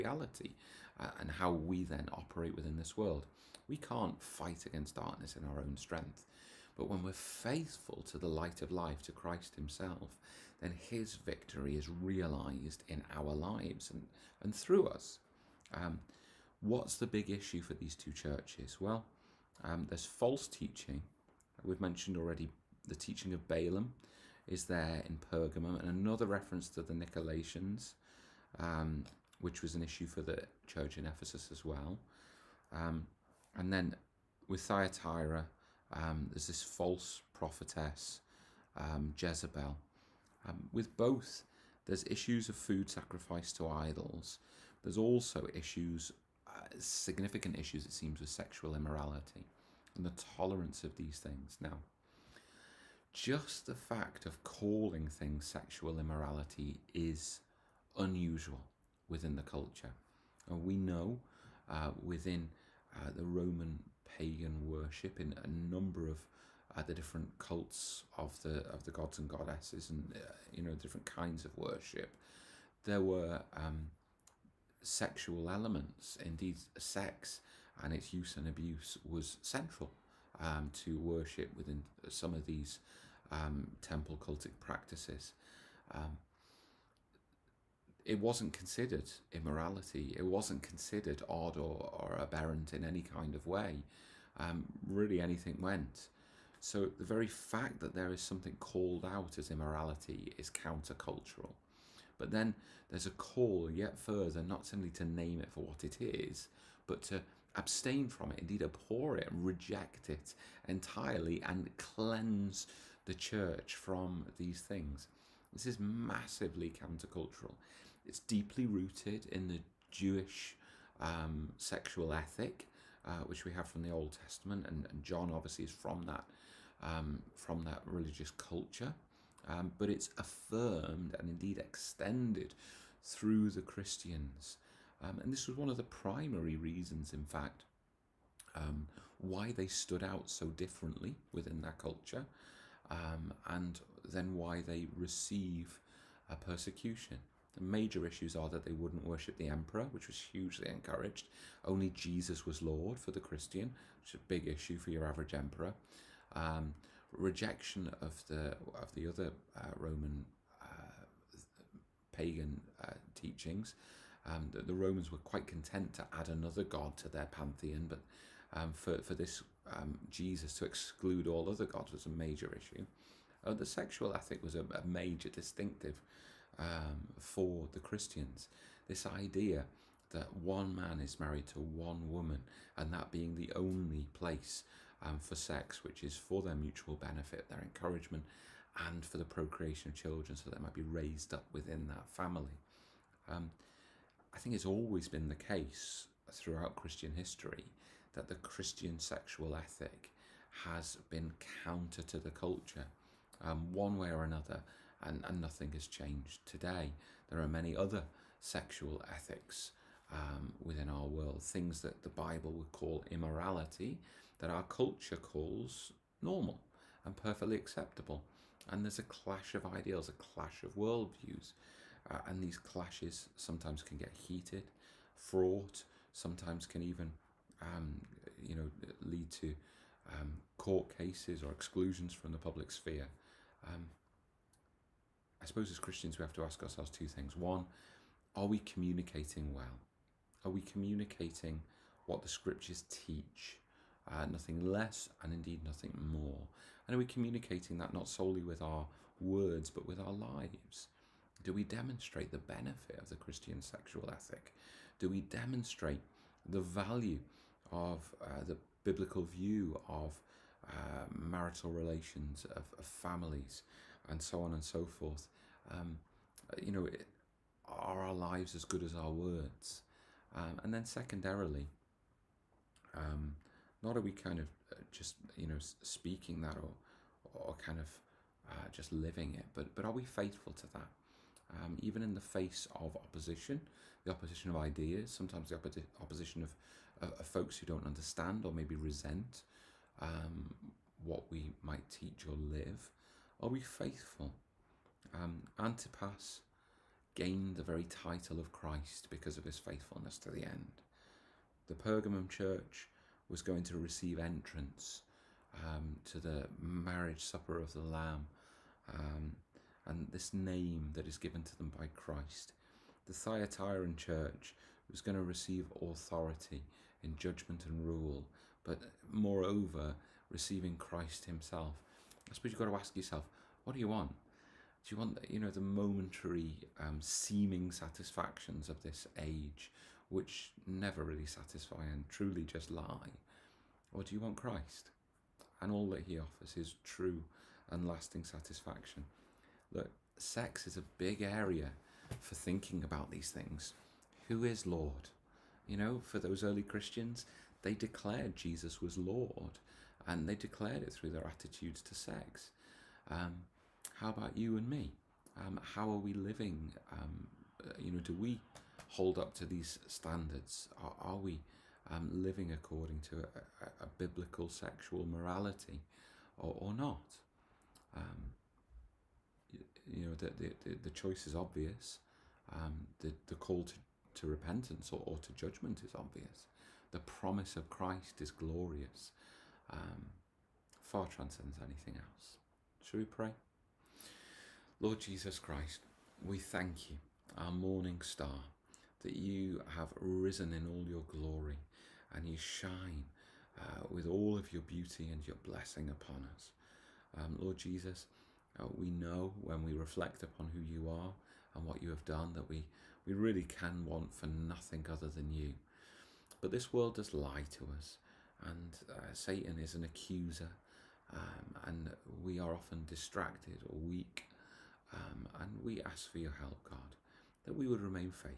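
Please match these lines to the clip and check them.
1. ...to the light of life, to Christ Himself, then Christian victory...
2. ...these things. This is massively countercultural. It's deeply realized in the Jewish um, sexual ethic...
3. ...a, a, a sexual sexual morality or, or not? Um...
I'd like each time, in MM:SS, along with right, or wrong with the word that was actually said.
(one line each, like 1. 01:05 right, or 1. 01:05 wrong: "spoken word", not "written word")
1. 00:08 wrong: "His", not "Christian"
2. 01:54 wrong: "rooted", not "realized"
3. 06:03 wrong: "biblical", not "sexual".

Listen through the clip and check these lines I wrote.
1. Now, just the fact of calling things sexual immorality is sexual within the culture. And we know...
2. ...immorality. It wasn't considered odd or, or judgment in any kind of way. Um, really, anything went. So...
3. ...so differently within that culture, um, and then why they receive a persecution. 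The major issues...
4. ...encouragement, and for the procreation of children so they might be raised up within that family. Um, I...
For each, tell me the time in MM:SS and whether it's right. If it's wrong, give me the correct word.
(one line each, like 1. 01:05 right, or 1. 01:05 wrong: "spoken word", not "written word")
1. 00:51 wrong: "unusual", not "sexual"
2. 01:29 wrong: "aberrant", not "judgment"
3. 02:20 right
4. 03:07 right.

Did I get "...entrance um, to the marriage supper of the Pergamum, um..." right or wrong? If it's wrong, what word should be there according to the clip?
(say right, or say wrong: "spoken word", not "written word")
wrong: "Lamb", not "Pergamum".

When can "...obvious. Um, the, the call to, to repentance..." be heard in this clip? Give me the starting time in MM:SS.
06:11.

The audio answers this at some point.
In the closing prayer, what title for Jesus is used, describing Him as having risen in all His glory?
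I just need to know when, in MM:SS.
06:27.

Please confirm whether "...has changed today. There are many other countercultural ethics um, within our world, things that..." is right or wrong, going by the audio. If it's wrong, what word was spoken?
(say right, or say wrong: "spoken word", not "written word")
wrong: "sexual", not "countercultural".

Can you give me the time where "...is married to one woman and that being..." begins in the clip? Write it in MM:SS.
03:00.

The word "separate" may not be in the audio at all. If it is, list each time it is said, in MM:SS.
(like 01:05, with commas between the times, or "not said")
not said.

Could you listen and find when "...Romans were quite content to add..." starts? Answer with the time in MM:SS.
02:44.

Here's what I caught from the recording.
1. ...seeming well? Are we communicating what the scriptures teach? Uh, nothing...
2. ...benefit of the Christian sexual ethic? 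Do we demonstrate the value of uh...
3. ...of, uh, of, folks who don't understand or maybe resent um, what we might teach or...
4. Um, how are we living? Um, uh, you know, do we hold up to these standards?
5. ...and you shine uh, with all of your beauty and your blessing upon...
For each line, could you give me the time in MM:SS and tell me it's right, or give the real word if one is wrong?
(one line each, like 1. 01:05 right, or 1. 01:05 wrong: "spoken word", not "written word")
1. 03:58 wrong: "communicating", not "seeming"
2. 04:12 right
3. 04:47 right
4. 05:55 right
5. 06:32 right.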